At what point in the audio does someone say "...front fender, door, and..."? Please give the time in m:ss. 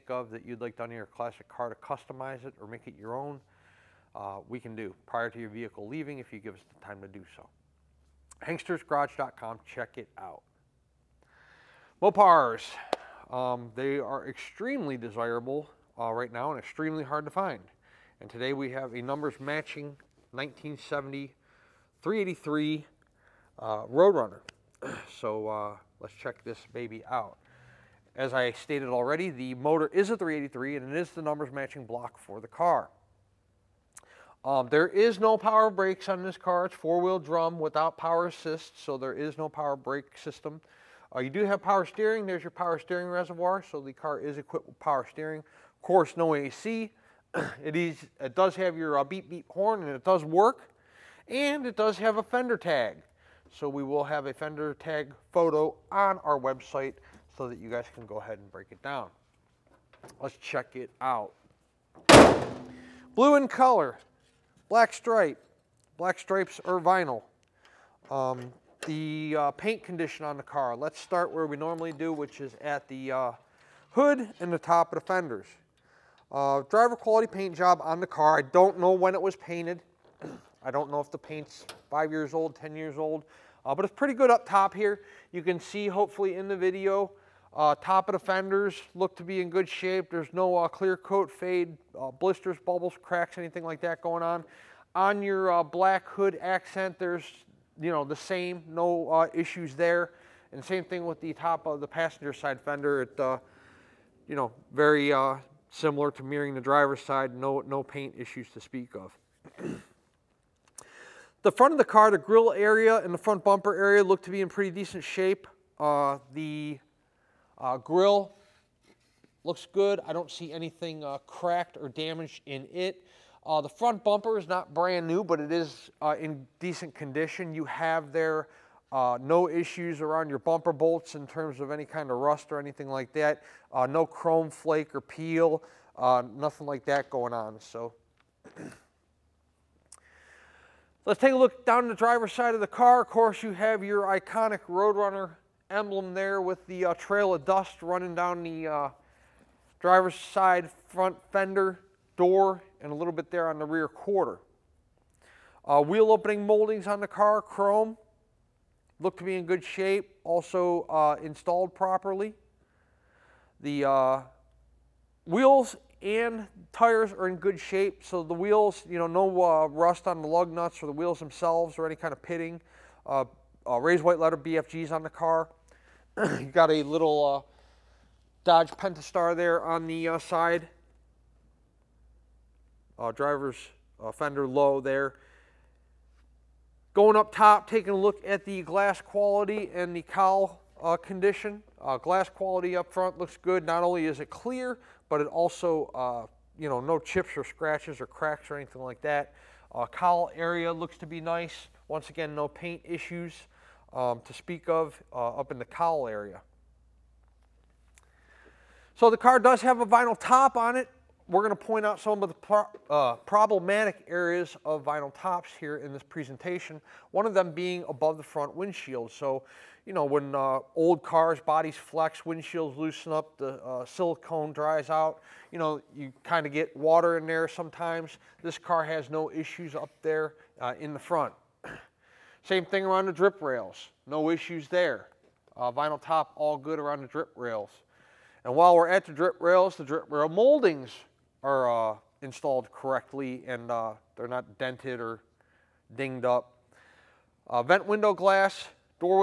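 2:30.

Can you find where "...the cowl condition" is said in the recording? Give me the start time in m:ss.
3:09.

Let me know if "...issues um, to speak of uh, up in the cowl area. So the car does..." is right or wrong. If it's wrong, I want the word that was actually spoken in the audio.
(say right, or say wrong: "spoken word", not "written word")
right.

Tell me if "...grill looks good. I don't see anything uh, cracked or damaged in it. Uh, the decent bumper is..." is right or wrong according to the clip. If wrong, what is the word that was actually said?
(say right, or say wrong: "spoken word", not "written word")
wrong: "front", not "decent".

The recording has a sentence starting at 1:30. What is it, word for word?
There's no uh, clear coat fade, uh, blisters, bubbles, cracks, anything like that going on.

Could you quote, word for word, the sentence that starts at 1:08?
Um, the uh, paint condition on the car.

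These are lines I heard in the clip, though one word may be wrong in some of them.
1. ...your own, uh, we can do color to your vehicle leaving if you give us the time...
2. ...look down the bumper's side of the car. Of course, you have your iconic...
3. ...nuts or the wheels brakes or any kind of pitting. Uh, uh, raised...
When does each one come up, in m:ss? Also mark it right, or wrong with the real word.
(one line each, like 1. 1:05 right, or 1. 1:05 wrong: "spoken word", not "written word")
1. 0:02 wrong: "prior", not "color"
2. 2:21 wrong: "driver", not "bumper"
3. 2:50 wrong: "themselves", not "brakes".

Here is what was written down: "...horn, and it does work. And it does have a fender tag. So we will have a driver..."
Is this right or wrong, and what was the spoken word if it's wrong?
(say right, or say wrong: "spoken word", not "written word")
wrong: "fender", not "driver".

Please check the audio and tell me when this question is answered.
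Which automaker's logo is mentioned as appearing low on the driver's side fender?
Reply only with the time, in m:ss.
2:58.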